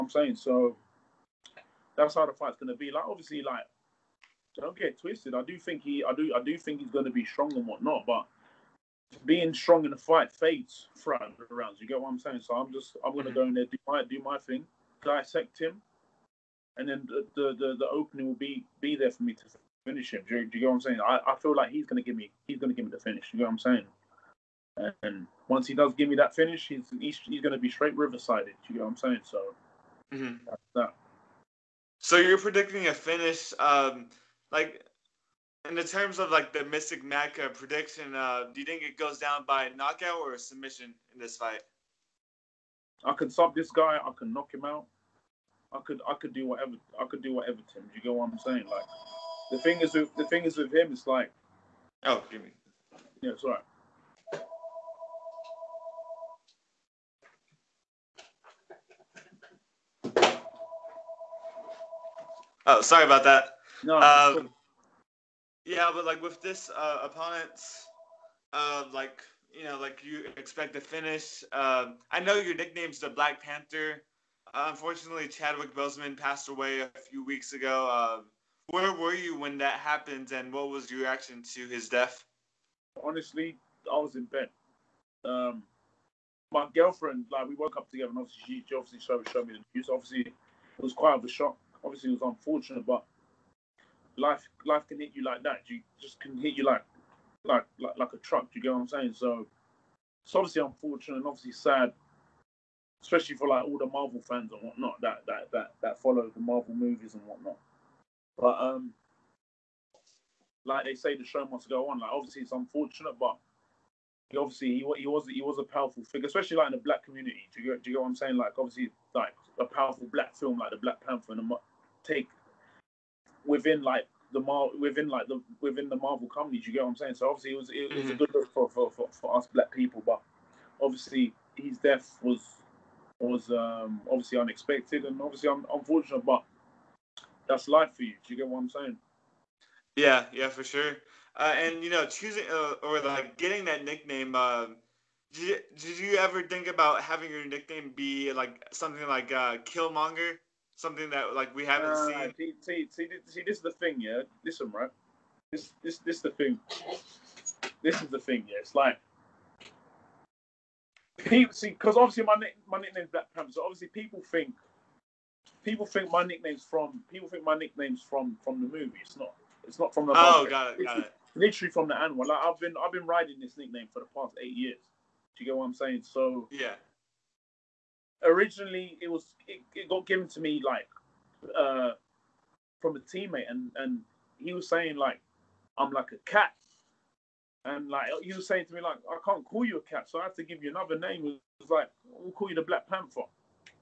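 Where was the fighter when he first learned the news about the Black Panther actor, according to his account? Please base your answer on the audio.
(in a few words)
In bed.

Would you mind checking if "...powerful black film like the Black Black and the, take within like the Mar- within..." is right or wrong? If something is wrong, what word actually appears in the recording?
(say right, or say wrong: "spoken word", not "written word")
wrong: "Panther", not "Black".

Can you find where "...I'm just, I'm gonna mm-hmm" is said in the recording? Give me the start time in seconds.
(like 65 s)
12 s.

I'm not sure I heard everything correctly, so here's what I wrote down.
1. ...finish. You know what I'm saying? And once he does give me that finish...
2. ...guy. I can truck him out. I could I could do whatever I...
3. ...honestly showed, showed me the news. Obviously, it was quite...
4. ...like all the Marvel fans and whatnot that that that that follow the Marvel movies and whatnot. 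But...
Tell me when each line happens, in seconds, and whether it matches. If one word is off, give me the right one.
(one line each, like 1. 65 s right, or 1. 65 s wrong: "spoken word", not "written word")
1. 23 s right
2. 43 s wrong: "knock", not "truck"
3. 88 s wrong: "obviously", not "honestly"
4. 103 s right.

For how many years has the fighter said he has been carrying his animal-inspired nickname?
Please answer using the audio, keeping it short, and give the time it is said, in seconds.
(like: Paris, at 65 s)
8, at 174 s.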